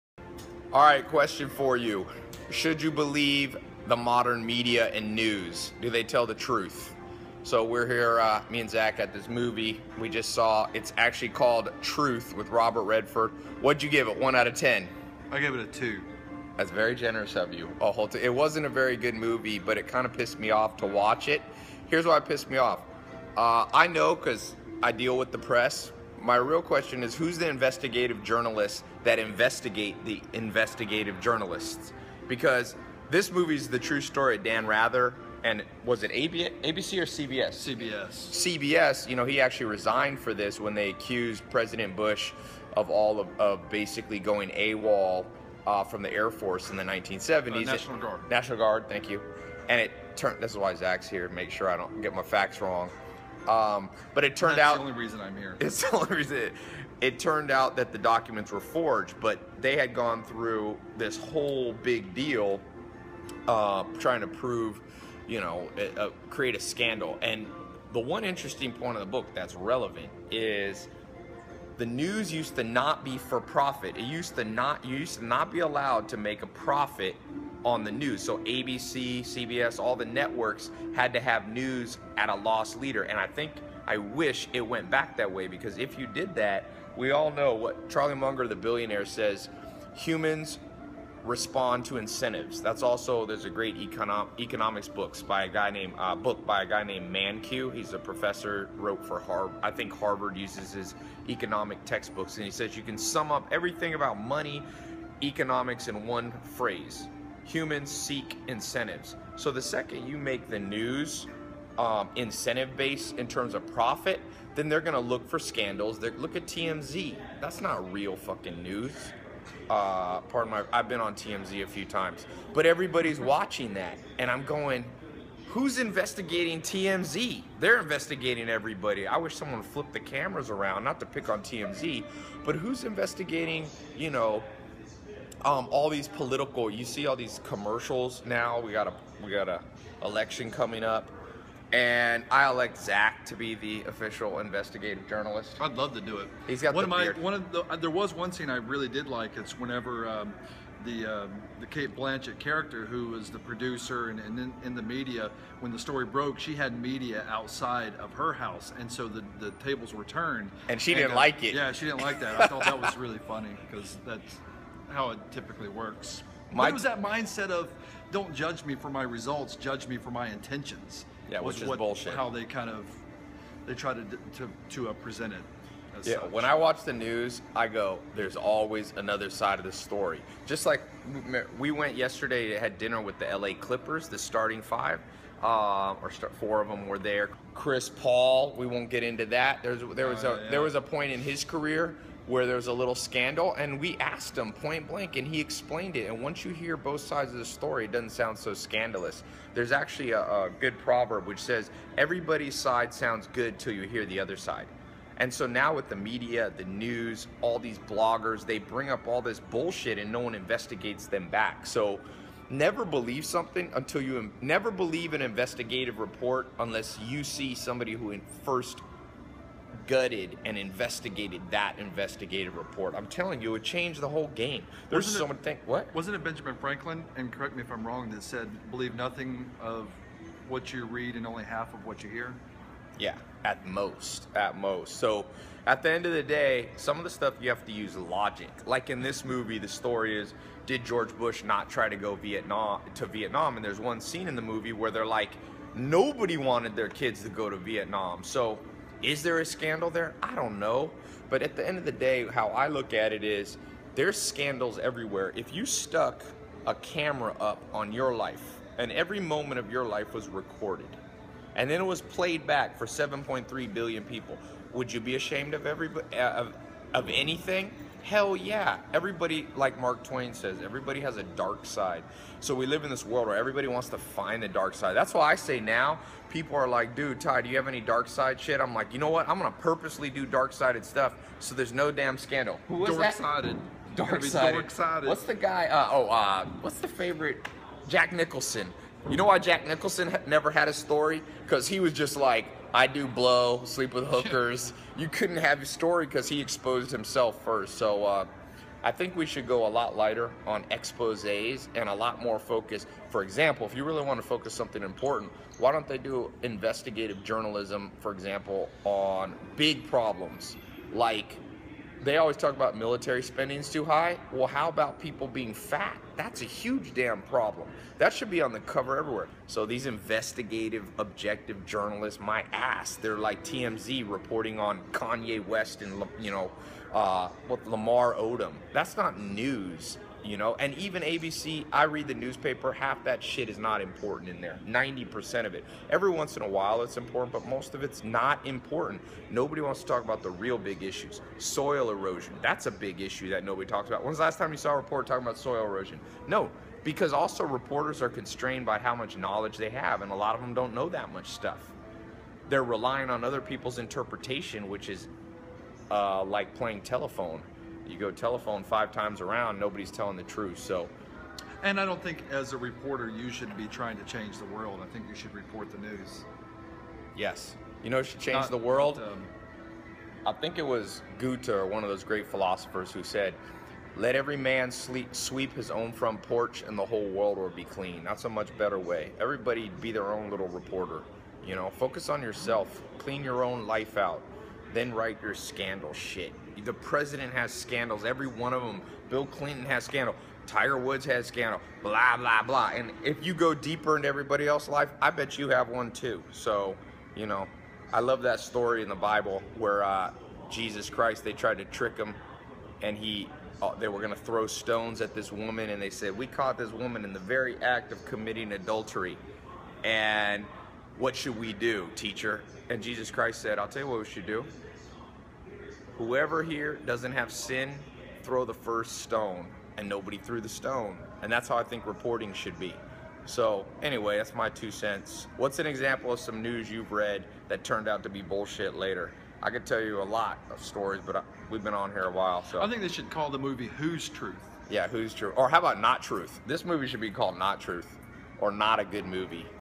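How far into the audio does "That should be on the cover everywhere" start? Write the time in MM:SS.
05:17.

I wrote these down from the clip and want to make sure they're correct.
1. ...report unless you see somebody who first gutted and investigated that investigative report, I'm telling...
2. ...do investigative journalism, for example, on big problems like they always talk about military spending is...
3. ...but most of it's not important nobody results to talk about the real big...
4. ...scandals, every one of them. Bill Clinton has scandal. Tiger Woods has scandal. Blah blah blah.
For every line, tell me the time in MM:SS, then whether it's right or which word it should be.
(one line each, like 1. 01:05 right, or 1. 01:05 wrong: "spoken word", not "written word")
1. 03:35 right
2. 05:05 right
3. 05:37 wrong: "wants", not "results"
4. 06:27 right.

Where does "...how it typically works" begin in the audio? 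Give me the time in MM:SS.
02:44.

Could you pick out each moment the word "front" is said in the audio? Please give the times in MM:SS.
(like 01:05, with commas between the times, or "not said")
06:15.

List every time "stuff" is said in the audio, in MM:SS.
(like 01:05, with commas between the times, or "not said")
03:57, 04:40, 05:51.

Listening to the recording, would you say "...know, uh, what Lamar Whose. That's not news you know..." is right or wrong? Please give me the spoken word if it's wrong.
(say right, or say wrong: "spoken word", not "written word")
wrong: "Odom", not "Whose".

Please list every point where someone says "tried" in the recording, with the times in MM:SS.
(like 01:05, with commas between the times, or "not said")
06:41.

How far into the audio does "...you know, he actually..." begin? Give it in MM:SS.
00:39.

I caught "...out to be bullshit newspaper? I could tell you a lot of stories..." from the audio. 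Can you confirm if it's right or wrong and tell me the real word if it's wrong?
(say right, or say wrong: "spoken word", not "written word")
wrong: "later", not "newspaper".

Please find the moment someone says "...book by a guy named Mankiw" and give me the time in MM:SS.
01:36.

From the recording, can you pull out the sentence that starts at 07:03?
So, anyway, that's my two cents.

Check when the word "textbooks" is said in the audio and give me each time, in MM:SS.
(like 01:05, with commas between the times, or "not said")
01:41.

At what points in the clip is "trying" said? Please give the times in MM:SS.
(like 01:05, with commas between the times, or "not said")
01:03, 06:03.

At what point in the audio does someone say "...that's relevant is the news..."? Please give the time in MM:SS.
01:09.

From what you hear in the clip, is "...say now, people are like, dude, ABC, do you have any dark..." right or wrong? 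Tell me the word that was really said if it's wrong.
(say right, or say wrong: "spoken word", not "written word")
wrong: "Tai", not "ABC".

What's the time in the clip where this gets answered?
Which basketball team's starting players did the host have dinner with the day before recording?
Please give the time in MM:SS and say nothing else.
03:03.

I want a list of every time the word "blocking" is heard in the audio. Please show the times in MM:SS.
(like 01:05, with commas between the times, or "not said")
not said.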